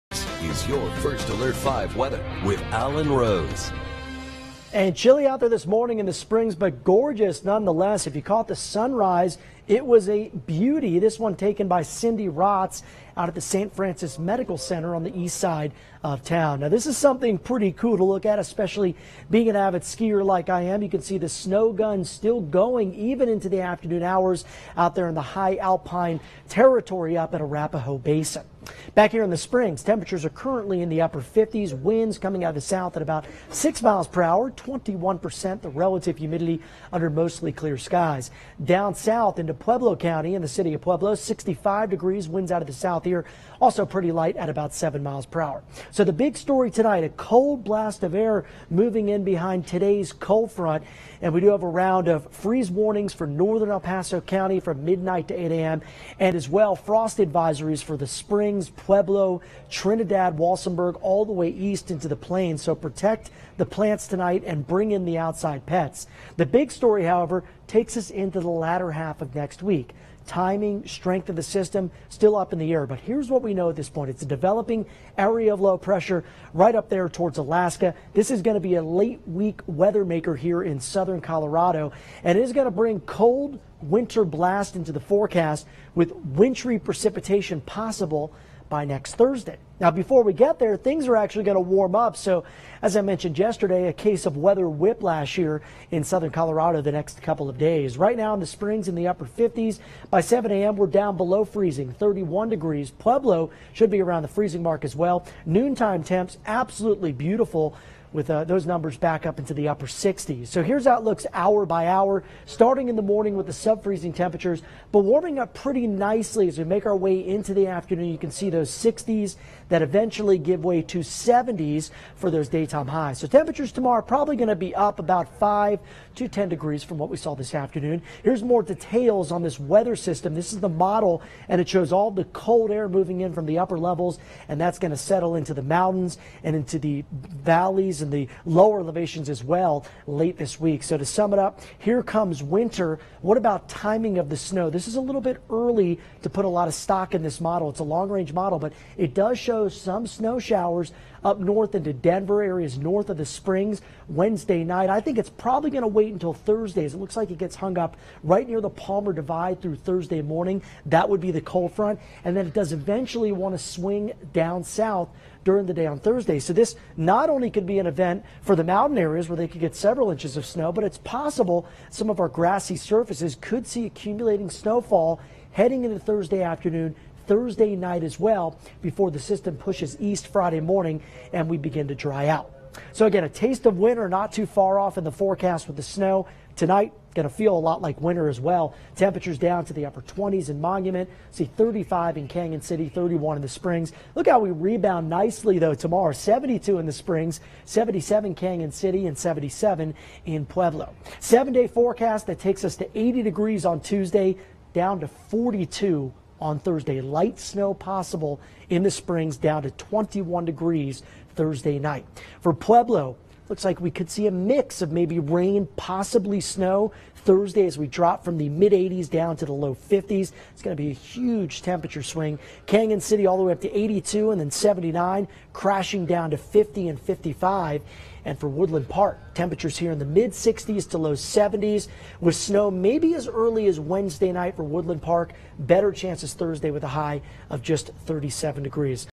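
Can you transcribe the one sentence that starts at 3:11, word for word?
See 35 in Cañon City, 31 in the Springs.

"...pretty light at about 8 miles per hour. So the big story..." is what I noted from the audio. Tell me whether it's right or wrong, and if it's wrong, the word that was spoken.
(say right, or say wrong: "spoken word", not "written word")
wrong: "7", not "8".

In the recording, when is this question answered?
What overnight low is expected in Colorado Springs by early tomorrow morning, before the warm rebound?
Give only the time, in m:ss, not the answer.
1:41.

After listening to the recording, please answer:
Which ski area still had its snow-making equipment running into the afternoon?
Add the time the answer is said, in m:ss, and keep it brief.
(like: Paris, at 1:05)
Arapahoe Basin, at 0:27.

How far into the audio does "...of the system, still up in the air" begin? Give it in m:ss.
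1:11.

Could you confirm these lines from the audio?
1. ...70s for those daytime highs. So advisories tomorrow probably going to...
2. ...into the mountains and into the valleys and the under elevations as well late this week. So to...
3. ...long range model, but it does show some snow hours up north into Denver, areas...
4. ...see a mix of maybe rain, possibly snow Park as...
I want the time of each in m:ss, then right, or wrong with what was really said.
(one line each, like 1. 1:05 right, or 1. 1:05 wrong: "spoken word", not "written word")
1. 2:00 wrong: "temperatures", not "advisories"
2. 2:15 wrong: "lower", not "under"
3. 2:27 wrong: "showers", not "hours"
4. 3:34 wrong: "Thursday", not "Park".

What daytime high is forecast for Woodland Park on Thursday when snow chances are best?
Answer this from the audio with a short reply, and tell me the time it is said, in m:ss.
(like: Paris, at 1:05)
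37 degrees, at 3:58.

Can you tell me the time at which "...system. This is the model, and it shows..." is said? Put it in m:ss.
2:09.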